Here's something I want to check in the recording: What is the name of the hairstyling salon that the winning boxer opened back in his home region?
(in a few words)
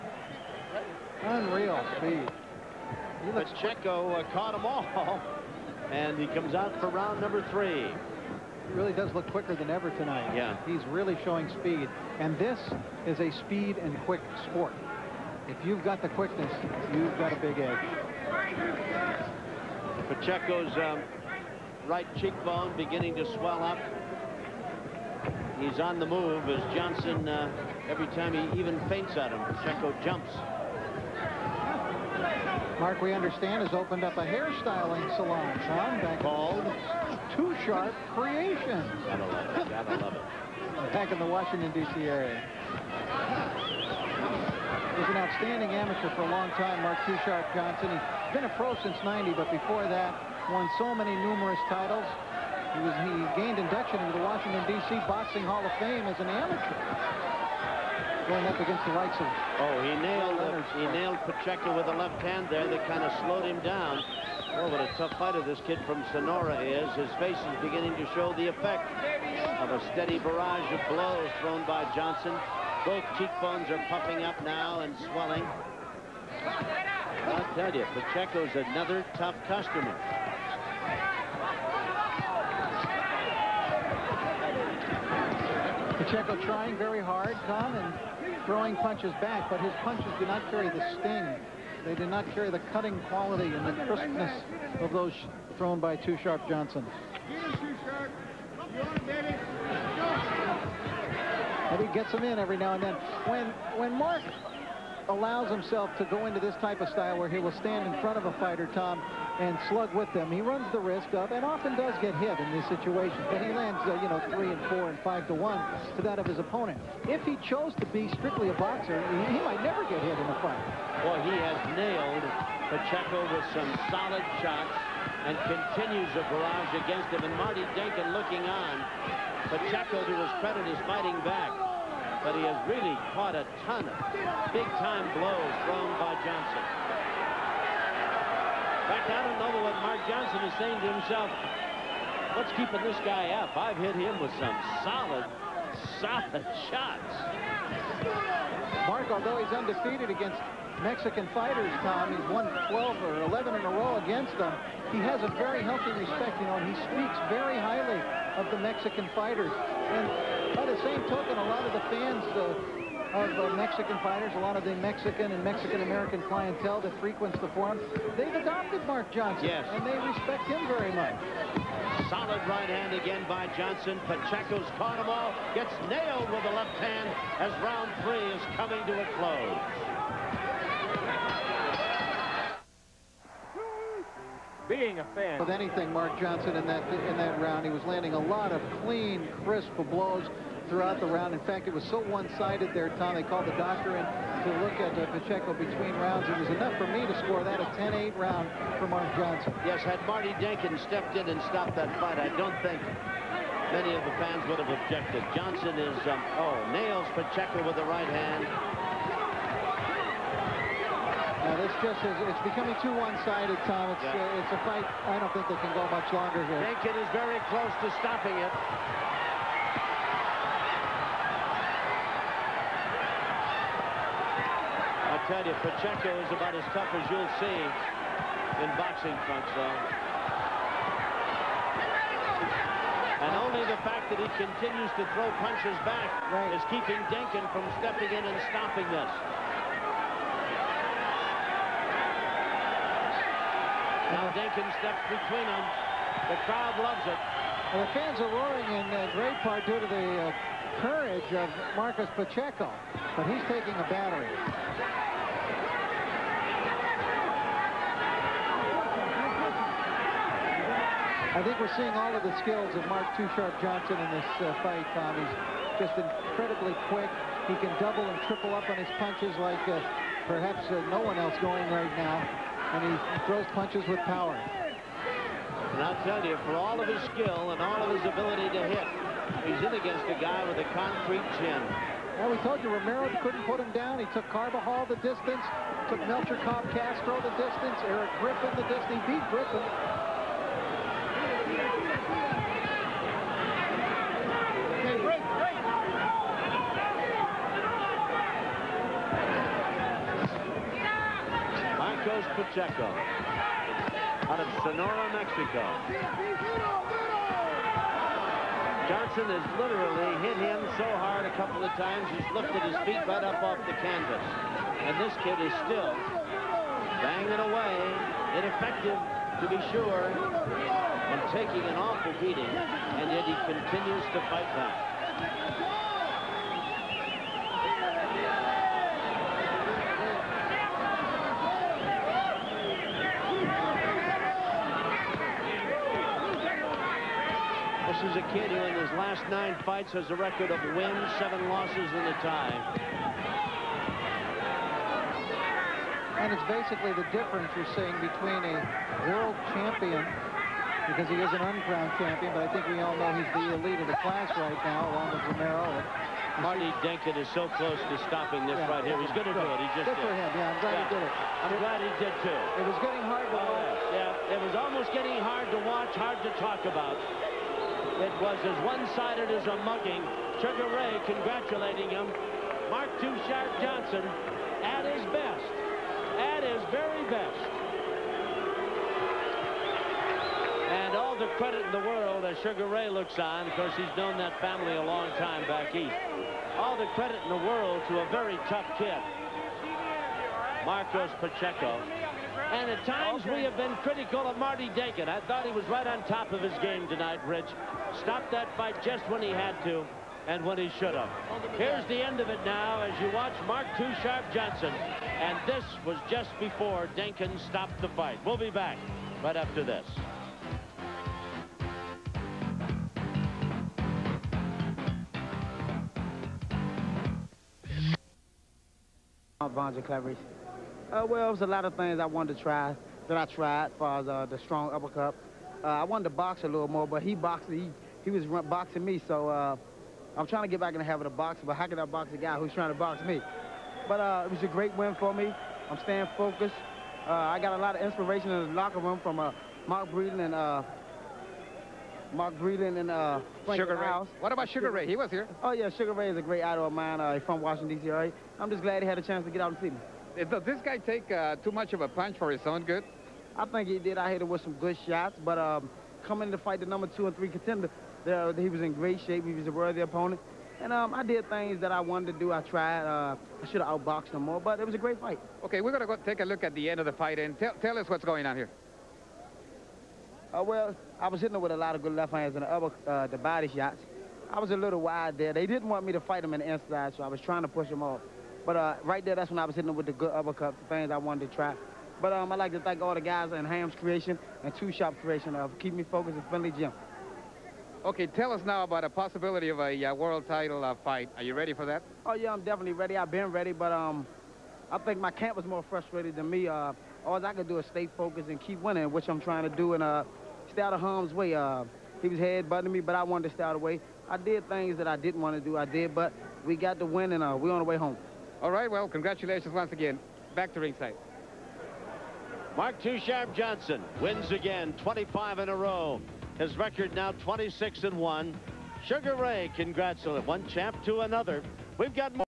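Two Sharp Creations.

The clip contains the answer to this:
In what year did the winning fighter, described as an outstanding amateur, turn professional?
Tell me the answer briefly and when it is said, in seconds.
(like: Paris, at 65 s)
1990, at 49 s.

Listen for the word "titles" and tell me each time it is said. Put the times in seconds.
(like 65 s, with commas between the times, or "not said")
51 s, 490 s.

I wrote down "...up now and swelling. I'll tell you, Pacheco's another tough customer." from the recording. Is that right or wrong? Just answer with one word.
right.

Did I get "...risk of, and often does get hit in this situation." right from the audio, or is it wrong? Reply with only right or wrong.
right.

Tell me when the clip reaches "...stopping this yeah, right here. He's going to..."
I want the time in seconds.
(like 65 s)
358 s.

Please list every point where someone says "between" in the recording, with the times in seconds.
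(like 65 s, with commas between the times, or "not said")
195 s, 245 s, 348 s.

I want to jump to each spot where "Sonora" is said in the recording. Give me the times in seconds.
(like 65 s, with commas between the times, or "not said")
66 s, 304 s.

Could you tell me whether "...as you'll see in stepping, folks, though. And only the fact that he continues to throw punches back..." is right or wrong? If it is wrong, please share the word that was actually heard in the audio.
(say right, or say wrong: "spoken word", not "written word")
wrong: "boxing", not "stepping".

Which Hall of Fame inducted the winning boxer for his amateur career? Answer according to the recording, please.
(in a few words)
Washington, D.C. Boxing Hall of Fame.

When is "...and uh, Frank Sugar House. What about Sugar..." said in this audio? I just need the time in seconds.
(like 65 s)
442 s.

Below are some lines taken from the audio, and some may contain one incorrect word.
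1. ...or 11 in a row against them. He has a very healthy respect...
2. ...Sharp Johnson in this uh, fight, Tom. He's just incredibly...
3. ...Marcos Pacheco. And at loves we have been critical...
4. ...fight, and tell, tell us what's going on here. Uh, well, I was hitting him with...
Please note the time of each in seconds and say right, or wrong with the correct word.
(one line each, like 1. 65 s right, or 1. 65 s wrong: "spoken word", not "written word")
1. 153 s right
2. 263 s right
3. 390 s wrong: "times", not "loves"
4. 466 s right.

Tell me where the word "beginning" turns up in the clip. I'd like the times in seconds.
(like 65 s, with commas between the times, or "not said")
22 s, 67 s.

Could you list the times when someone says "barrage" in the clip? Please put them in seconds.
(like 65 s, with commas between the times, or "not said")
70 s, 126 s.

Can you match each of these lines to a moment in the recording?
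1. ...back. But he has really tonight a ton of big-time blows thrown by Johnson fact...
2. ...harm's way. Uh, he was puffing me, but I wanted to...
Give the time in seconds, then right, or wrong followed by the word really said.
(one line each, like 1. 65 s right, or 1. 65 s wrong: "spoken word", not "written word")
1. 131 s wrong: "caught", not "tonight"
2. 500 s wrong: "headbutting", not "puffing".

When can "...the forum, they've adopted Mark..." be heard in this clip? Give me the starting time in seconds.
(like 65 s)
167 s.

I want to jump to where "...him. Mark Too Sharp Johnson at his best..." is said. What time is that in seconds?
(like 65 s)
371 s.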